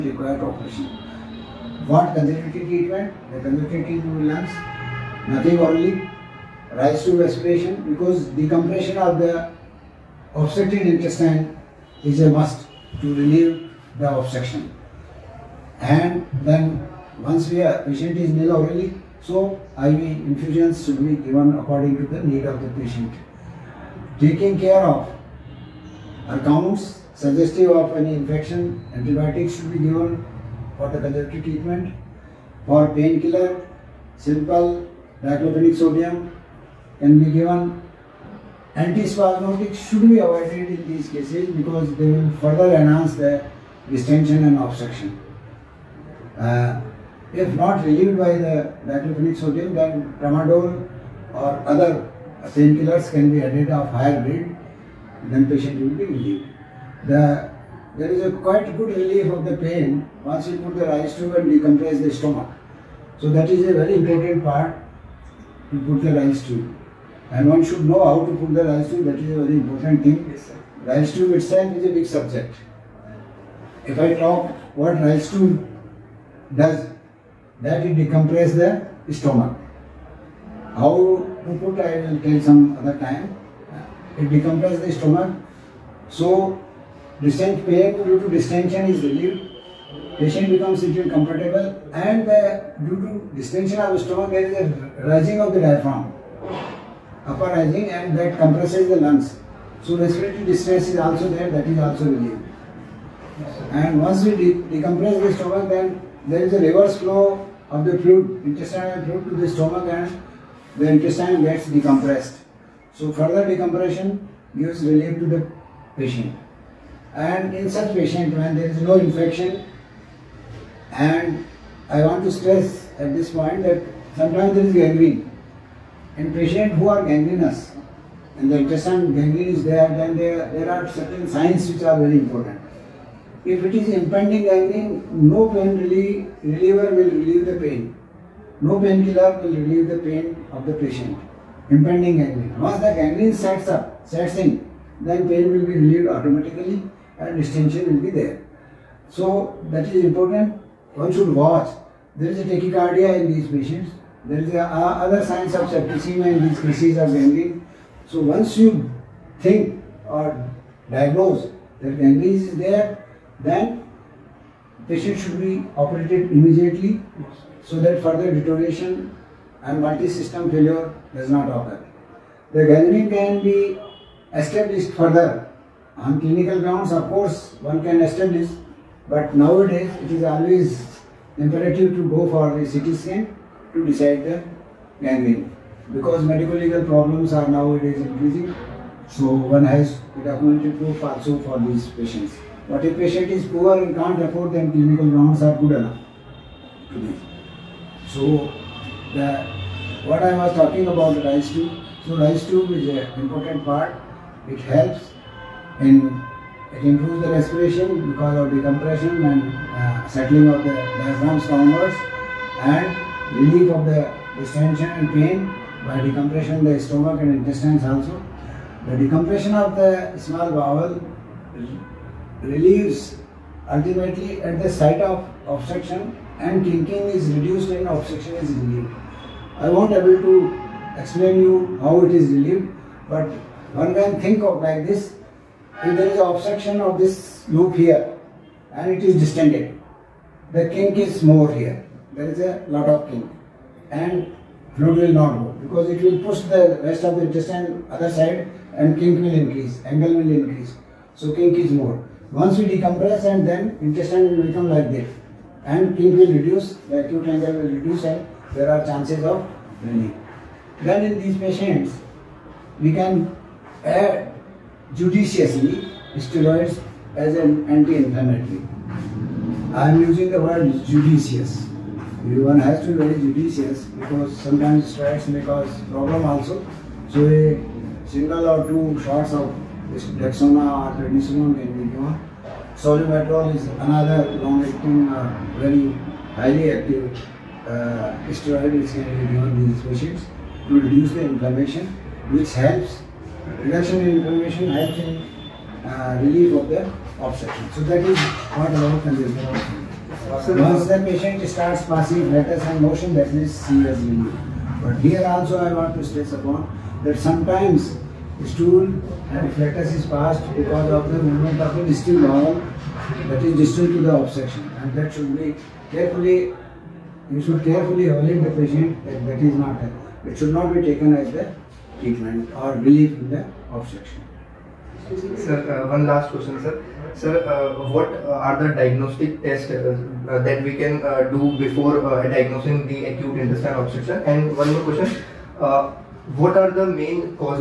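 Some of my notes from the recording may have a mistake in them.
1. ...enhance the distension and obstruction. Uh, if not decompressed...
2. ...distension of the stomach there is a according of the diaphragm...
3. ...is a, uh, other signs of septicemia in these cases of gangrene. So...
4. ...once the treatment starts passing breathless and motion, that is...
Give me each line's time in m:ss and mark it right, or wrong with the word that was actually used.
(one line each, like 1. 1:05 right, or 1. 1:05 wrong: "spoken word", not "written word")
1. 0:42 wrong: "relieved", not "decompressed"
2. 1:33 wrong: "rising", not "according"
3. 2:34 right
4. 5:00 wrong: "patient", not "treatment".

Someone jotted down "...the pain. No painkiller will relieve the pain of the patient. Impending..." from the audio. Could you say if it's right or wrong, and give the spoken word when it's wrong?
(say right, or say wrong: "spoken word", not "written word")
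right.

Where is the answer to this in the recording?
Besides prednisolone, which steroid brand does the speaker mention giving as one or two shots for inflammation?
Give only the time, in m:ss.
4:39.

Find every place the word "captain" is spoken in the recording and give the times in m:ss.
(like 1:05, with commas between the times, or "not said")
not said.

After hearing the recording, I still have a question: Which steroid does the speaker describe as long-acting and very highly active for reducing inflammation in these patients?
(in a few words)
Solu-Medrol.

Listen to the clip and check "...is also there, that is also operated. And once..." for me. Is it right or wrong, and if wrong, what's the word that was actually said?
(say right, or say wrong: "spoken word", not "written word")
wrong: "relieved", not "operated".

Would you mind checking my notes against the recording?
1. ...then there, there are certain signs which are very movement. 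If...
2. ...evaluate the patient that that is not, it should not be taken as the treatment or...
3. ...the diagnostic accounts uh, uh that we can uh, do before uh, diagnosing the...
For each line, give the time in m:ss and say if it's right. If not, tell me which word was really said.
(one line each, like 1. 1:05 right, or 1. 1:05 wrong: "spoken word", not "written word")
1. 2:09 wrong: "important", not "movement"
2. 5:18 right
3. 5:28 wrong: "tests", not "accounts".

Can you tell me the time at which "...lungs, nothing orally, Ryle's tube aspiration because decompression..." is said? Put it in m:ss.
0:04.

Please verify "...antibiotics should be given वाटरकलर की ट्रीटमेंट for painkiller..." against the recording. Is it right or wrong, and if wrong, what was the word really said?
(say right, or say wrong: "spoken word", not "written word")
right.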